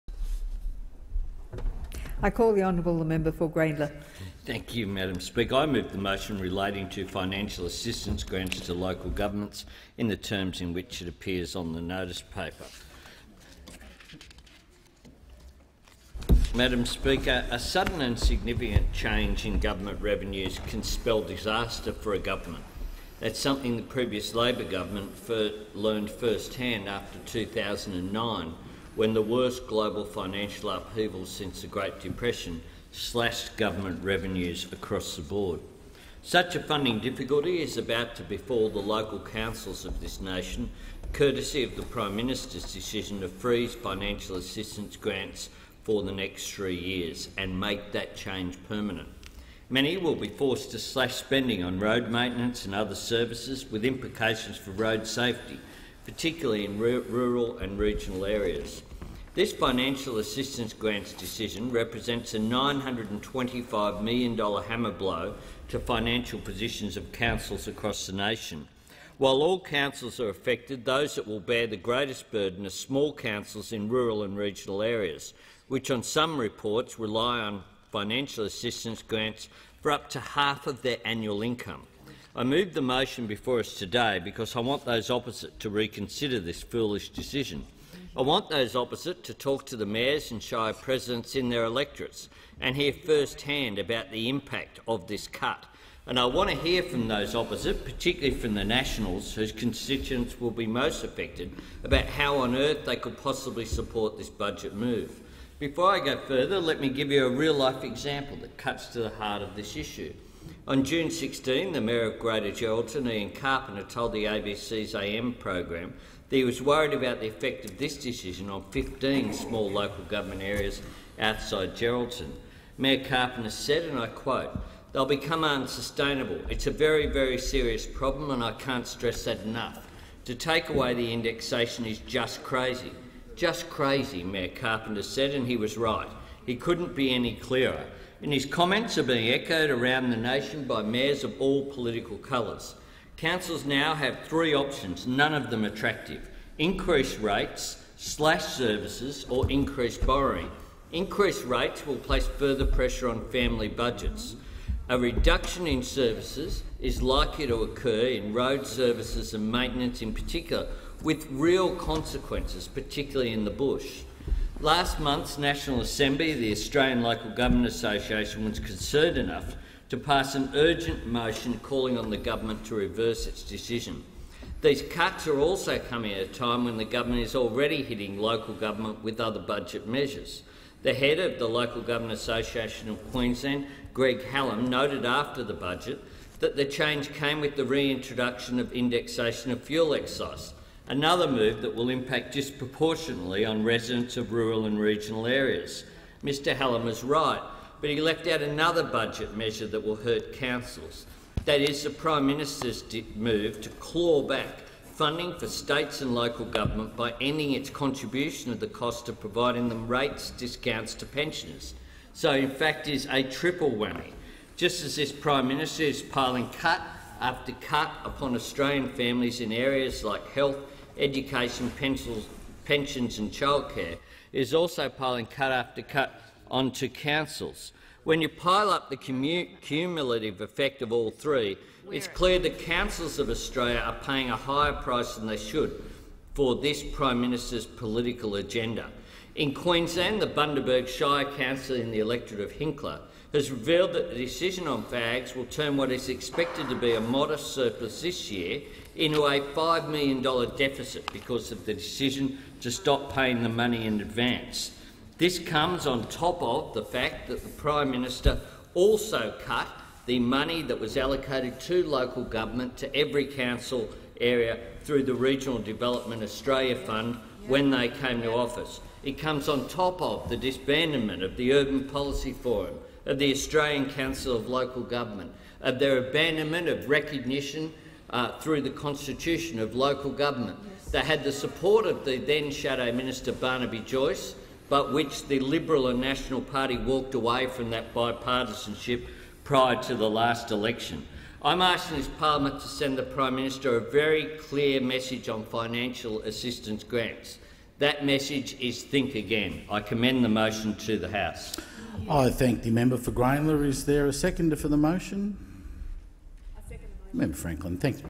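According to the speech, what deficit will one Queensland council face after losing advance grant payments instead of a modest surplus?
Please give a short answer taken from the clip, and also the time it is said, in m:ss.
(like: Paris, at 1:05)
$5 million, at 4:09.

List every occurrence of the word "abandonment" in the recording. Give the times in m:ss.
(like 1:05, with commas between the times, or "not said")
4:36.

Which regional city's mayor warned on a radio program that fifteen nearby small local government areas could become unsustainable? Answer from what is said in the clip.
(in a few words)
Greater Geraldton.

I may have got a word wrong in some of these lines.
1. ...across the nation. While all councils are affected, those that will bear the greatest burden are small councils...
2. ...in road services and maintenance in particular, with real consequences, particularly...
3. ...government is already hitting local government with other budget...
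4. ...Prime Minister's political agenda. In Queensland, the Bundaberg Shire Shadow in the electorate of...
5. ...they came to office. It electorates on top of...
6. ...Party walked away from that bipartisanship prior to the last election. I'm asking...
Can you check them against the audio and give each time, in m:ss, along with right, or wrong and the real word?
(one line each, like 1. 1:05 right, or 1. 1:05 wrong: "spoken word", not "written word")
1. 1:07 right
2. 2:38 right
3. 2:56 right
4. 3:56 wrong: "Council", not "Shadow"
5. 4:27 wrong: "comes", not "electorates"
6. 4:46 right.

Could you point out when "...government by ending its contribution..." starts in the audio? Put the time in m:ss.
3:26.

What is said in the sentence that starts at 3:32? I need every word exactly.
So in fact is a triple whammy.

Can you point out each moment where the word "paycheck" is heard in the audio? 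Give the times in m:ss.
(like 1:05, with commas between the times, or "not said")
not said.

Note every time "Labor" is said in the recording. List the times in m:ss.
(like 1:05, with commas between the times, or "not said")
0:24.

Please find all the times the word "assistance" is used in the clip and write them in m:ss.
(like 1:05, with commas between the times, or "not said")
0:07, 0:44, 1:00, 1:18, 4:56.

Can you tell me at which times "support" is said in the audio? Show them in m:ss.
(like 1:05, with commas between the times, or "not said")
1:43, 4:41.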